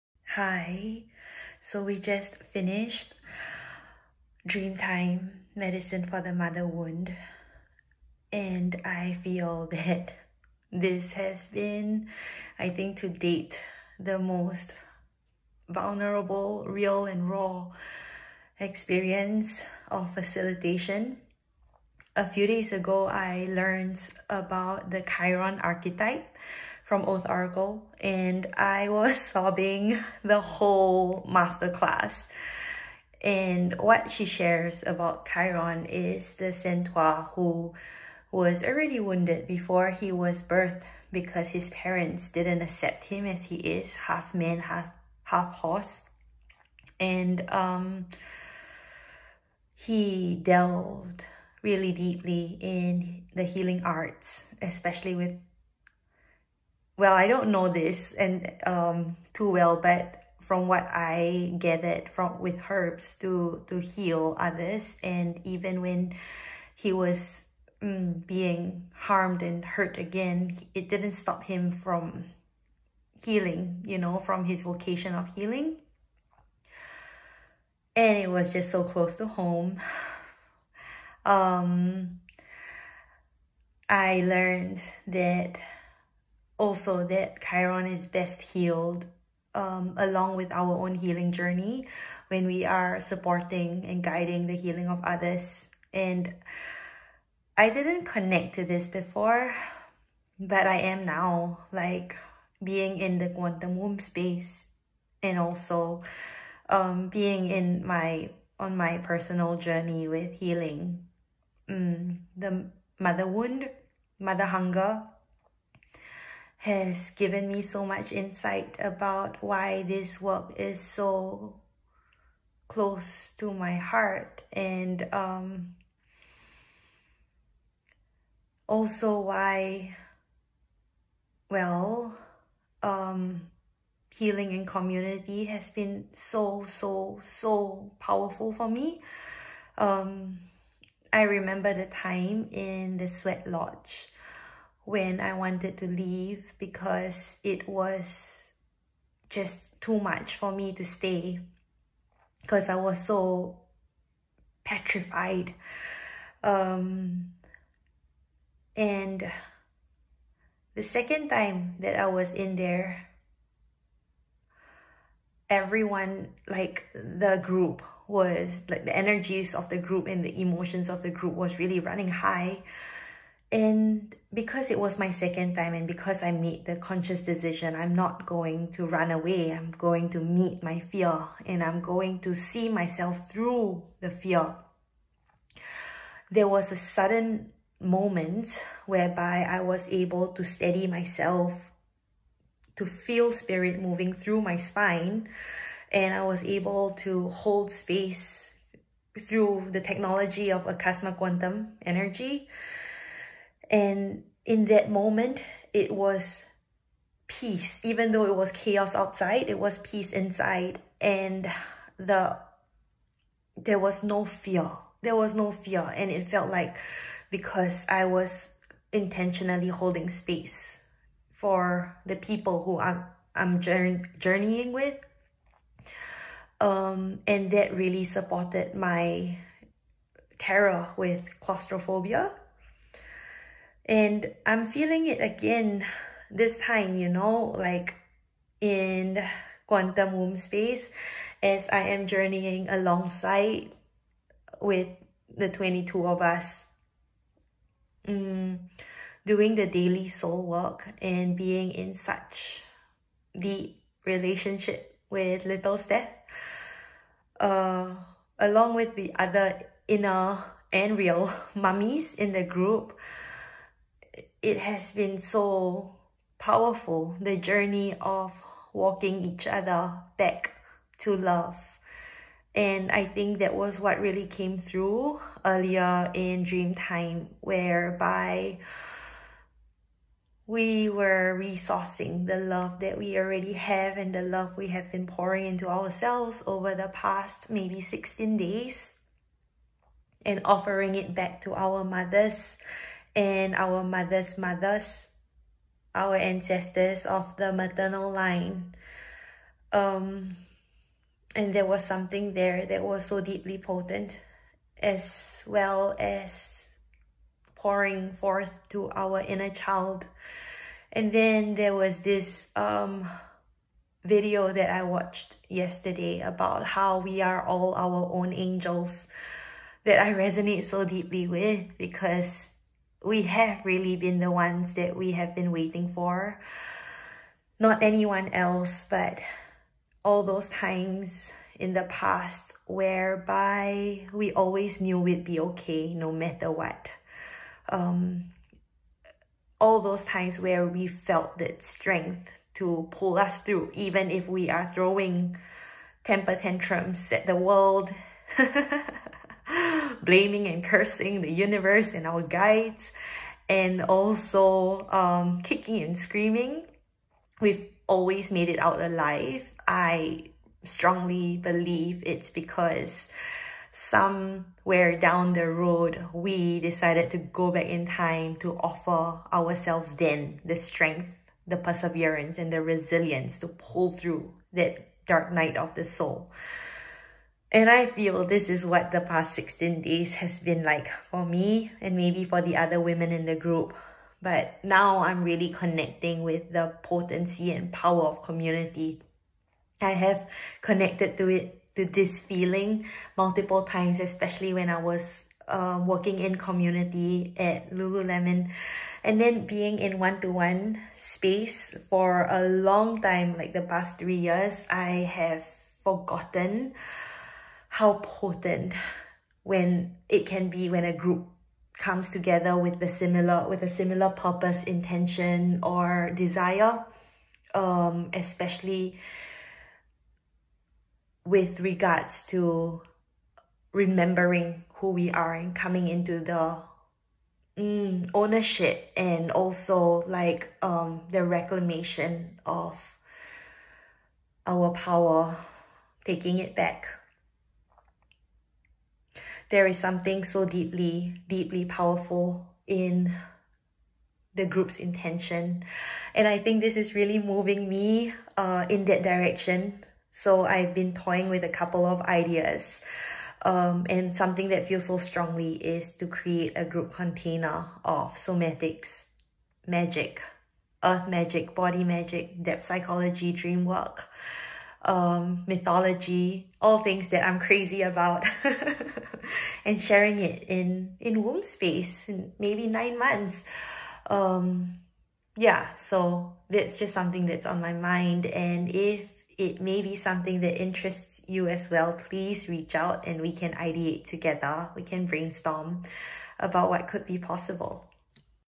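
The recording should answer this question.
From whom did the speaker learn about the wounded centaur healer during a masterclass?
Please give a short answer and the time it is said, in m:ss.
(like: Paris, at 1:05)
Oath Oracle, at 0:27.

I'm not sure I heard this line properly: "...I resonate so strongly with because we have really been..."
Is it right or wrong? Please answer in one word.
wrong.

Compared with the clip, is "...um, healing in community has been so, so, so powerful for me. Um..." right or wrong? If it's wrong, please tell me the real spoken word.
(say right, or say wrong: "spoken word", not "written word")
right.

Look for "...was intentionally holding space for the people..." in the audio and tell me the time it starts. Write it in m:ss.
3:38.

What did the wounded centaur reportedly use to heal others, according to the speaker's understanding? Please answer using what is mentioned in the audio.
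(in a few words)
Herbs.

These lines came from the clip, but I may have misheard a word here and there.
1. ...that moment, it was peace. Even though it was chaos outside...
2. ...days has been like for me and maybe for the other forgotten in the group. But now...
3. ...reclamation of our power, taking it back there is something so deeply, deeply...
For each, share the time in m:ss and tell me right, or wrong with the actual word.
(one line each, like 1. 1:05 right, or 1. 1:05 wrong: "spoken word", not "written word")
1. 3:24 right
2. 6:19 wrong: "women", not "forgotten"
3. 7:11 right.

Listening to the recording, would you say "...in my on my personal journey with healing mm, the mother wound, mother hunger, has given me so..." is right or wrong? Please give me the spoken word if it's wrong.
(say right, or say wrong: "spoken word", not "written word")
right.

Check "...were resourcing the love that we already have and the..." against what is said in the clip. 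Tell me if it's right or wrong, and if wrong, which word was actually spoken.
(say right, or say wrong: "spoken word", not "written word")
right.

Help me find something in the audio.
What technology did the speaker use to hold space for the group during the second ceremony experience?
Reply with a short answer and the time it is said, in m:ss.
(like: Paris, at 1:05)
Akasma Quantum Energy, at 3:20.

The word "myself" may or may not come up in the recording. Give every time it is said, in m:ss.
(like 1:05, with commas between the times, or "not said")
3:02, 3:10.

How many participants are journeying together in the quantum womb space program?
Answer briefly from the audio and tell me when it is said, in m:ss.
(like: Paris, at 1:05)
22, at 4:05.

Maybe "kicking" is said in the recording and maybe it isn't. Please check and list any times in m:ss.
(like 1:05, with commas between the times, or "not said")
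5:55.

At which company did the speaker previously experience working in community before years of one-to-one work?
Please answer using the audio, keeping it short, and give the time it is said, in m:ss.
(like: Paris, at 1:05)
Lululemon, at 6:37.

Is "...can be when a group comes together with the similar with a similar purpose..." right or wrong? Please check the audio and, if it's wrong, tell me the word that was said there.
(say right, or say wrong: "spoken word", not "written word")
right.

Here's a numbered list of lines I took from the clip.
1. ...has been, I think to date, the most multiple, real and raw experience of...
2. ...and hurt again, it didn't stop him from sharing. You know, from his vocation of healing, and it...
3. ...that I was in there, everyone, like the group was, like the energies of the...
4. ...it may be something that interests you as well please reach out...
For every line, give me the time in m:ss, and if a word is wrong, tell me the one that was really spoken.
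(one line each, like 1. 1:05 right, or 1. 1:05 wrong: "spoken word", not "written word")
1. 0:11 wrong: "vulnerable", not "multiple"
2. 1:09 wrong: "healing", not "sharing"
3. 2:41 right
4. 7:59 right.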